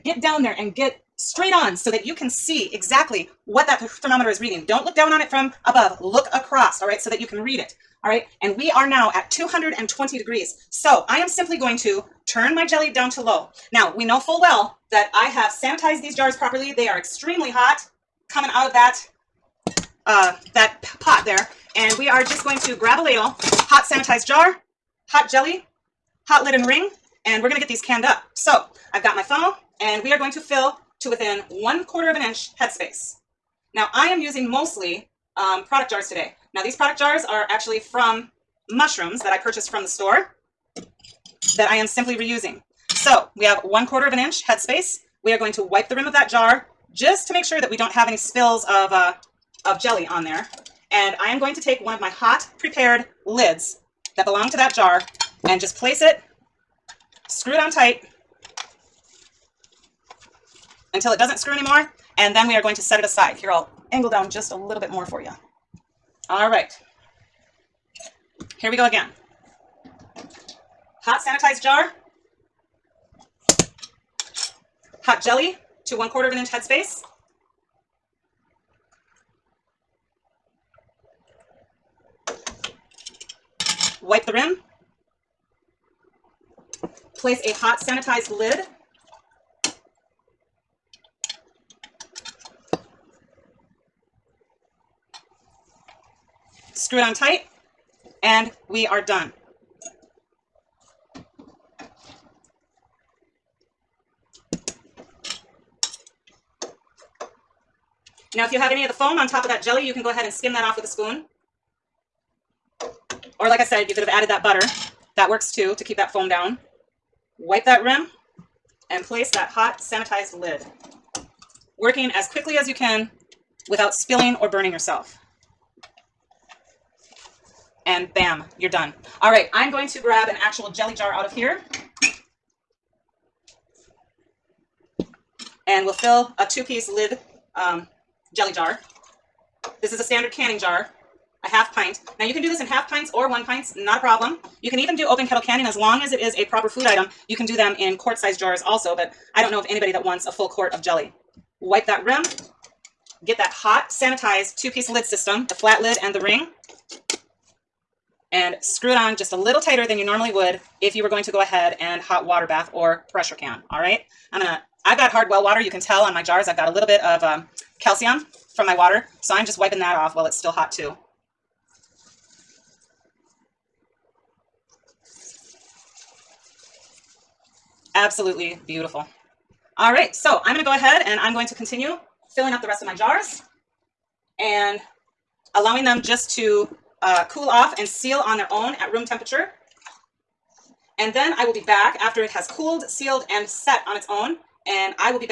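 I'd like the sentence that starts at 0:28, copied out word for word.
So I've got my funnel and we are going to fill to within one quarter of an inch headspace.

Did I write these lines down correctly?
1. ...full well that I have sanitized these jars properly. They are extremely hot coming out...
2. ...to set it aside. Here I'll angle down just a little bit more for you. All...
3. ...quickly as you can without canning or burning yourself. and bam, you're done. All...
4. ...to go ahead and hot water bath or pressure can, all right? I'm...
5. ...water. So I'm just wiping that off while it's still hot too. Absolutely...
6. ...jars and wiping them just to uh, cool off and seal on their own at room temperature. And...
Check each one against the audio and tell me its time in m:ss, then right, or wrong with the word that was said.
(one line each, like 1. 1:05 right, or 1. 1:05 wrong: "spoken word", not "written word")
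1. 0:14 right
2. 1:02 right
3. 2:02 wrong: "spilling", not "canning"
4. 2:41 right
5. 2:48 right
6. 3:02 wrong: "allowing", not "wiping".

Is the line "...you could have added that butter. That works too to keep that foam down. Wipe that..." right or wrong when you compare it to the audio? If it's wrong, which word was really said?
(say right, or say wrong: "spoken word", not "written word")
right.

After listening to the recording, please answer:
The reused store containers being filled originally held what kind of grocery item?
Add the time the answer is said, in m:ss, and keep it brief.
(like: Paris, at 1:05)
mushrooms, at 0:38.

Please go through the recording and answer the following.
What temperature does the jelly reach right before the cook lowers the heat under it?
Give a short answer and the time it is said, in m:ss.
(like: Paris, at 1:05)
220 degrees, at 0:09.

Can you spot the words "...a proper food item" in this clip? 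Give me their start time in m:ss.
2:26.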